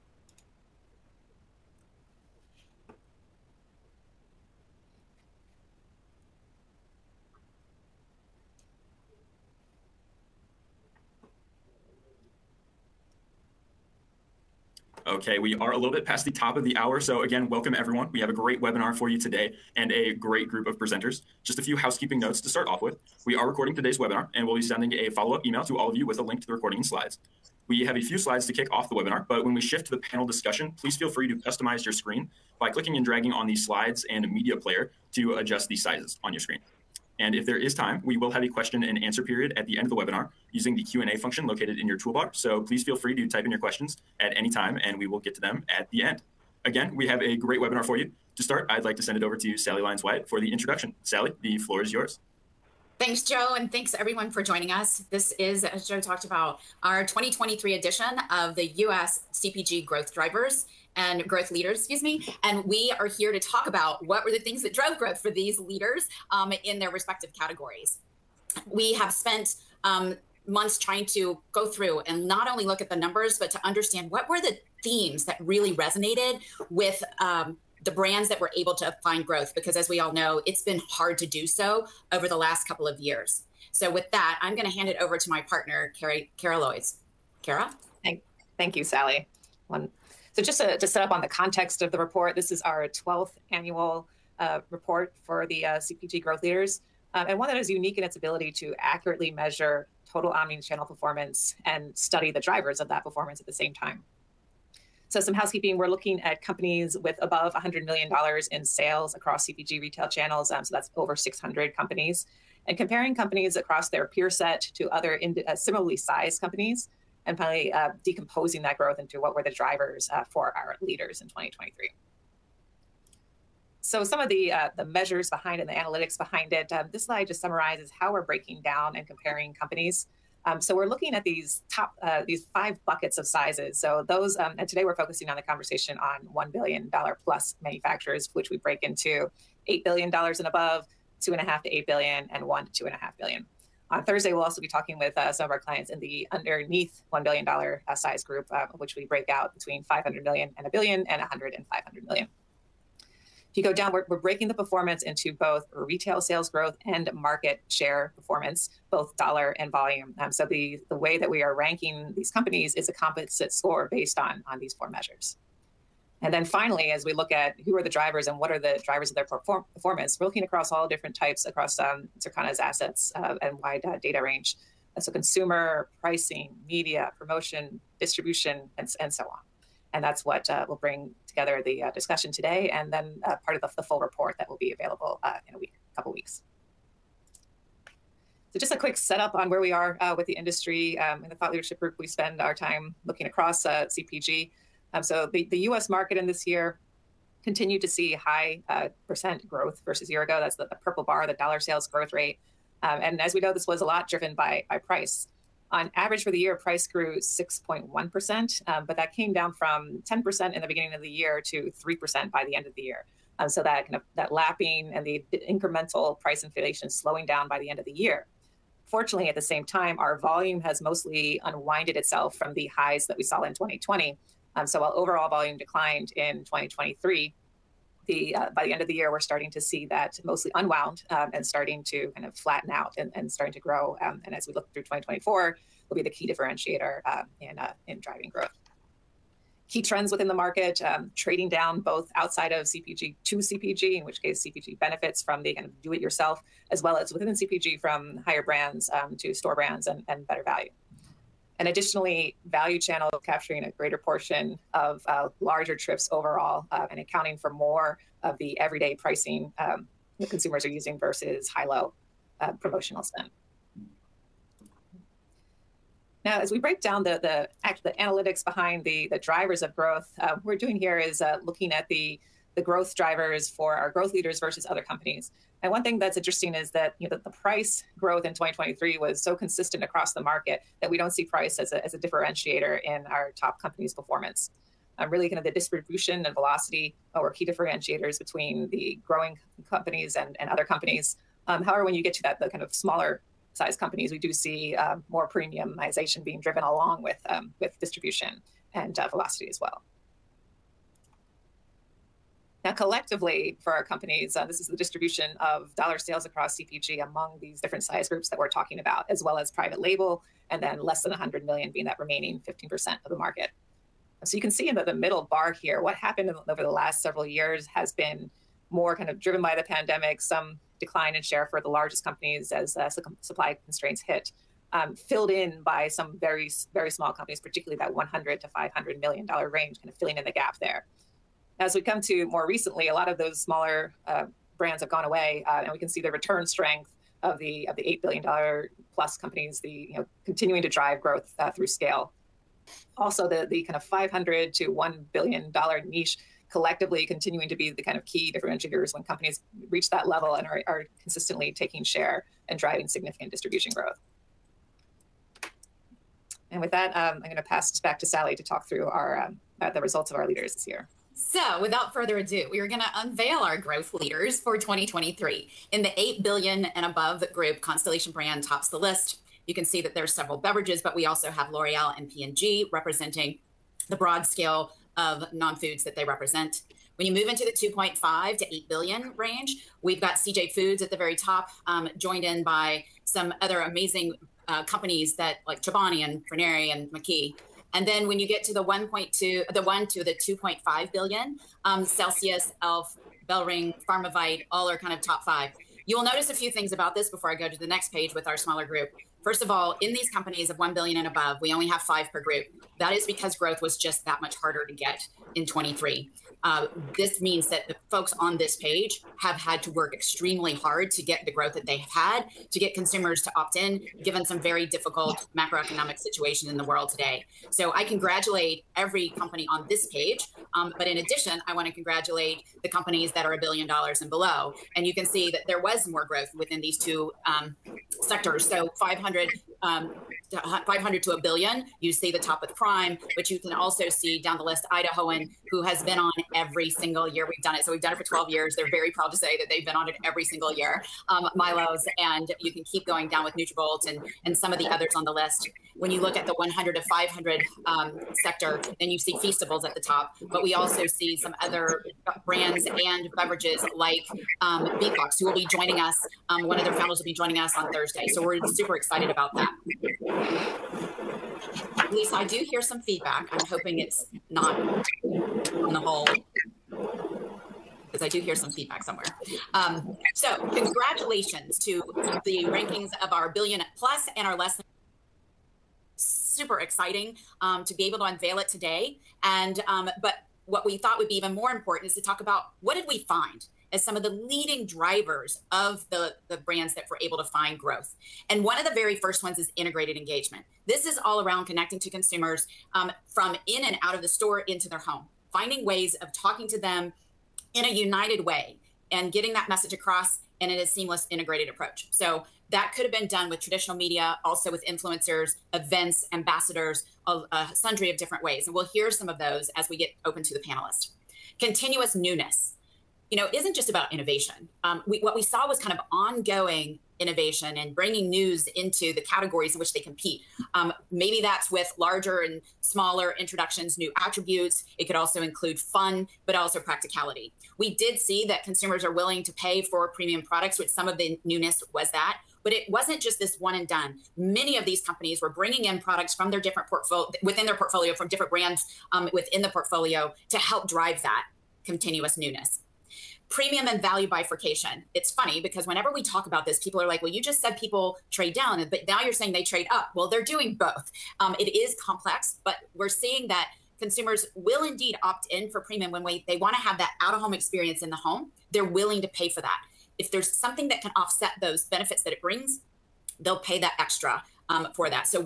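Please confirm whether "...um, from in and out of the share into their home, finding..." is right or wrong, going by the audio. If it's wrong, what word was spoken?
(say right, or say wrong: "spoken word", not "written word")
wrong: "store", not "share".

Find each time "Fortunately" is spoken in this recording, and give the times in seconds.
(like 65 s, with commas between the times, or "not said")
218 s.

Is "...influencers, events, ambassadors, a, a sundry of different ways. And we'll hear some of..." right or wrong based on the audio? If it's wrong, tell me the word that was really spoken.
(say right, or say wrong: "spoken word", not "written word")
right.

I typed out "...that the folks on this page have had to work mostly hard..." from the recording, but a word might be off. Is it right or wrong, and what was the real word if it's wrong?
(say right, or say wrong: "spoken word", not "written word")
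wrong: "extremely", not "mostly".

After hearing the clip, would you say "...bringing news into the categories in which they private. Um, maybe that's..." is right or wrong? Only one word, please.
wrong.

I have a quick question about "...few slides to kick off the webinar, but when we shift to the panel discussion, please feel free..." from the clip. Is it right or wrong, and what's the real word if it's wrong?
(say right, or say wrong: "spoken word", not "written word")
right.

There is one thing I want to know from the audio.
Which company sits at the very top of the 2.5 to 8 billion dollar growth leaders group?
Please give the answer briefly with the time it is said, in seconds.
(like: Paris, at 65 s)
CJ Foods, at 380 s.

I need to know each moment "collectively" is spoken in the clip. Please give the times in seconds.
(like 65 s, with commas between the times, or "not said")
302 s, 346 s.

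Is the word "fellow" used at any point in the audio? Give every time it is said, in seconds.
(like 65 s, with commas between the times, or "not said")
not said.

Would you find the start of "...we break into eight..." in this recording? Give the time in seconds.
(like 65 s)
138 s.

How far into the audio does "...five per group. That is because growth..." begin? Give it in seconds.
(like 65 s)
401 s.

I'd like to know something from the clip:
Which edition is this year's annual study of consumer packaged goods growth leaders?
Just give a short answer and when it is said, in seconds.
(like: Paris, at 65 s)
12th, at 92 s.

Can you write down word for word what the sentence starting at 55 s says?
This is, as Joe talked about, our 2023 edition of the U.S.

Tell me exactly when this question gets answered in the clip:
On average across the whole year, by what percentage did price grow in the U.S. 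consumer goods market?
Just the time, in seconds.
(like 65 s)
207 s.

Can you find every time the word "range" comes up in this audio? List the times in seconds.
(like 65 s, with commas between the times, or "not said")
174 s, 329 s, 379 s.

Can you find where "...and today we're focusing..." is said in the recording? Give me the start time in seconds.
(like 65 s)
134 s.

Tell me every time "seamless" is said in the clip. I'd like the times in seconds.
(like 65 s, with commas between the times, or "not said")
500 s.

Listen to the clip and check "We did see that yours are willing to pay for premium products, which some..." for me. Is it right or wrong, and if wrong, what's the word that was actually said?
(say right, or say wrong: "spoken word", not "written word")
wrong: "consumers", not "yours".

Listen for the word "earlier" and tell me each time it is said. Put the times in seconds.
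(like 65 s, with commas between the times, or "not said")
not said.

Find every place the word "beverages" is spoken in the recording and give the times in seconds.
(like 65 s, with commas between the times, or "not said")
370 s, 453 s.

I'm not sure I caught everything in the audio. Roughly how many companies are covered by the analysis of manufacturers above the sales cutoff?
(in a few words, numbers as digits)
over 600.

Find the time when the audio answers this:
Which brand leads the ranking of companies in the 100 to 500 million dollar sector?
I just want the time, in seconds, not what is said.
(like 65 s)
449 s.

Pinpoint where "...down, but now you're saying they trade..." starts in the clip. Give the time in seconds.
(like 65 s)
548 s.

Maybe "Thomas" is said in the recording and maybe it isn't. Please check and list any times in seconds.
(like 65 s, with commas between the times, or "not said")
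not said.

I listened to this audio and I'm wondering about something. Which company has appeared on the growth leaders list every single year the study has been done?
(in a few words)
Idahoan.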